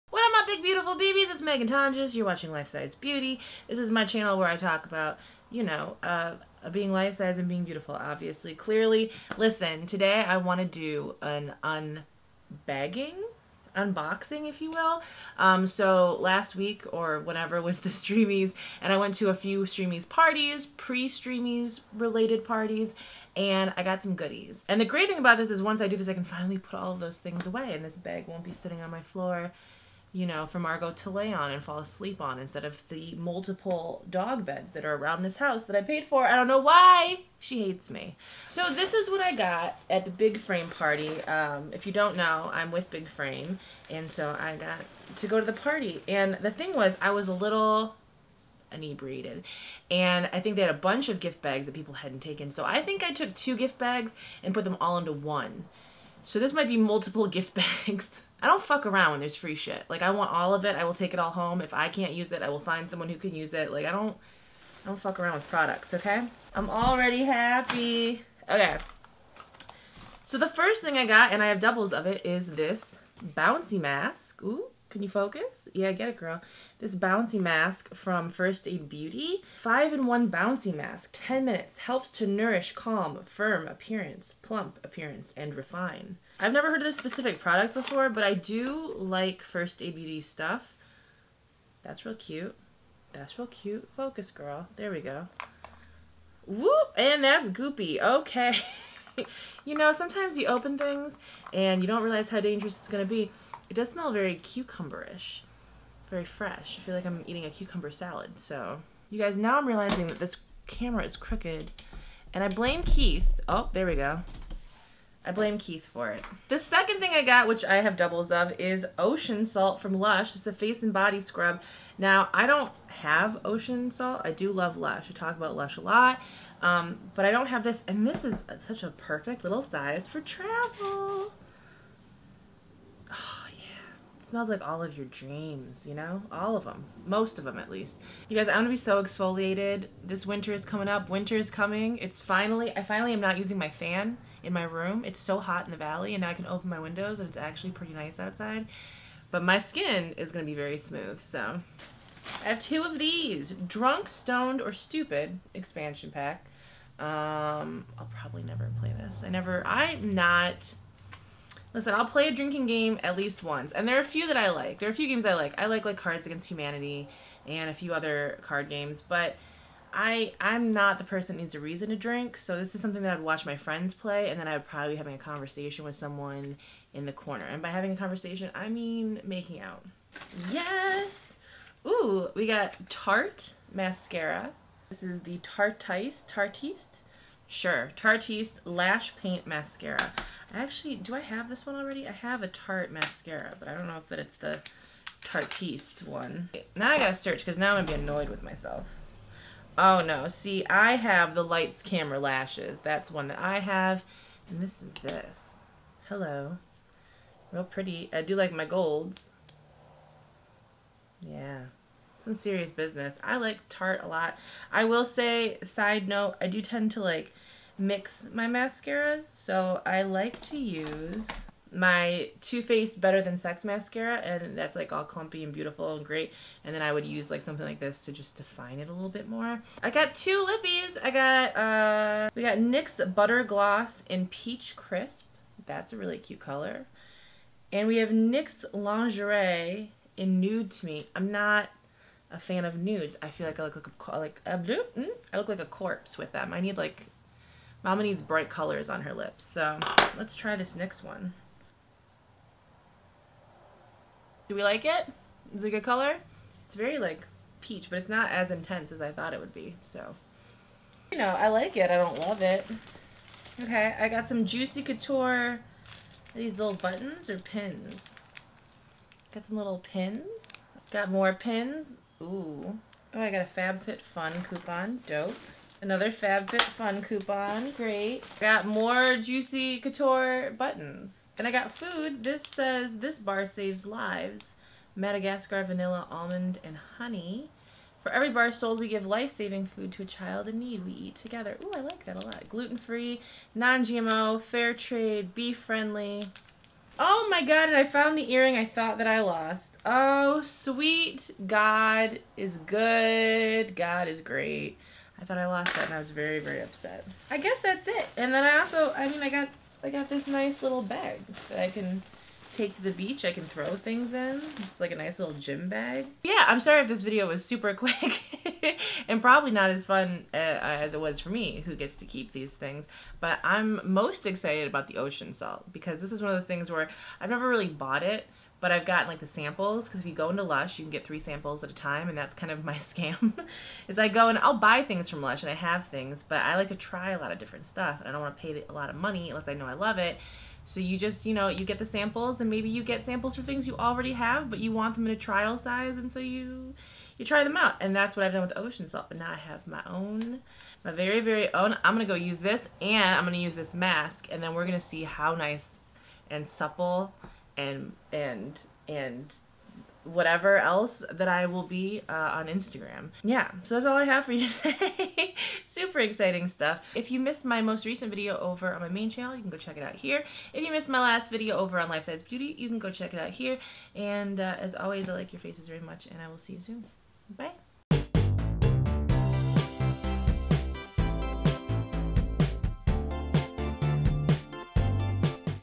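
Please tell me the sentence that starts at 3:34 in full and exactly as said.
I will say, side note, I do tend to like mix my mascaras.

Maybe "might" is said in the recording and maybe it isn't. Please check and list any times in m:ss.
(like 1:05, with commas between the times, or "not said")
0:56.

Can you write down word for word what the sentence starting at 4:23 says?
Okay, I got some Juicy Couture.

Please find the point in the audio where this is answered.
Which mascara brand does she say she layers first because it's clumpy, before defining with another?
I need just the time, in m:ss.
3:42.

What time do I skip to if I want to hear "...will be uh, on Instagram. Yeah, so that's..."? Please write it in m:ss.
6:01.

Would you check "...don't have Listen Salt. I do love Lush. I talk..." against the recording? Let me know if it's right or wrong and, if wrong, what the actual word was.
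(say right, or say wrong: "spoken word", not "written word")
wrong: "Ocean", not "Listen".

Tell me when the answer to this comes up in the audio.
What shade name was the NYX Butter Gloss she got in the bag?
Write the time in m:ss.
3:54.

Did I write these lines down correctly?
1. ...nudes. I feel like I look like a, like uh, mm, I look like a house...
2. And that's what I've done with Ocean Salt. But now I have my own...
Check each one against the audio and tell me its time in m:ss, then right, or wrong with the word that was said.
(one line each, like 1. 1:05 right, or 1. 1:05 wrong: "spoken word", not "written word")
1. 4:02 wrong: "corpse", not "house"
2. 5:47 right.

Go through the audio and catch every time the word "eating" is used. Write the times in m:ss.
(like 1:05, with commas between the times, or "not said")
1:47.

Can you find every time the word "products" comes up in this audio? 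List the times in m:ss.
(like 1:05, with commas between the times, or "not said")
1:05, 1:27.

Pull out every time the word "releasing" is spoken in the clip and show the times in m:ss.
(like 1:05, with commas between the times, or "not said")
not said.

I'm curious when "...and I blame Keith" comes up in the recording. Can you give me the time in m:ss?
1:52.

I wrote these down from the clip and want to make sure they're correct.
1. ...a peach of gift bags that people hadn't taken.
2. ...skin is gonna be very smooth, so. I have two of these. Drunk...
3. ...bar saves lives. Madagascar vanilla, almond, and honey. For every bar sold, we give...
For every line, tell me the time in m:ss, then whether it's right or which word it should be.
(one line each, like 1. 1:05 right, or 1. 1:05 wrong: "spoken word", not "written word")
1. 0:50 wrong: "bunch", not "peach"
2. 2:29 right
3. 4:43 right.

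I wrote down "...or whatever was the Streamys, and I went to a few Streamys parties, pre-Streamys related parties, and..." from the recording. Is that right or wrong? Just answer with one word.
right.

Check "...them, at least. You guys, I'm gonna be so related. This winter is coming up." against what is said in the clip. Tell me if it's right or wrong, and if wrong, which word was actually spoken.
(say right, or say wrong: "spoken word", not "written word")
wrong: "exfoliated", not "related".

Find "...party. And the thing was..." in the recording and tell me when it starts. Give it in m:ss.
0:45.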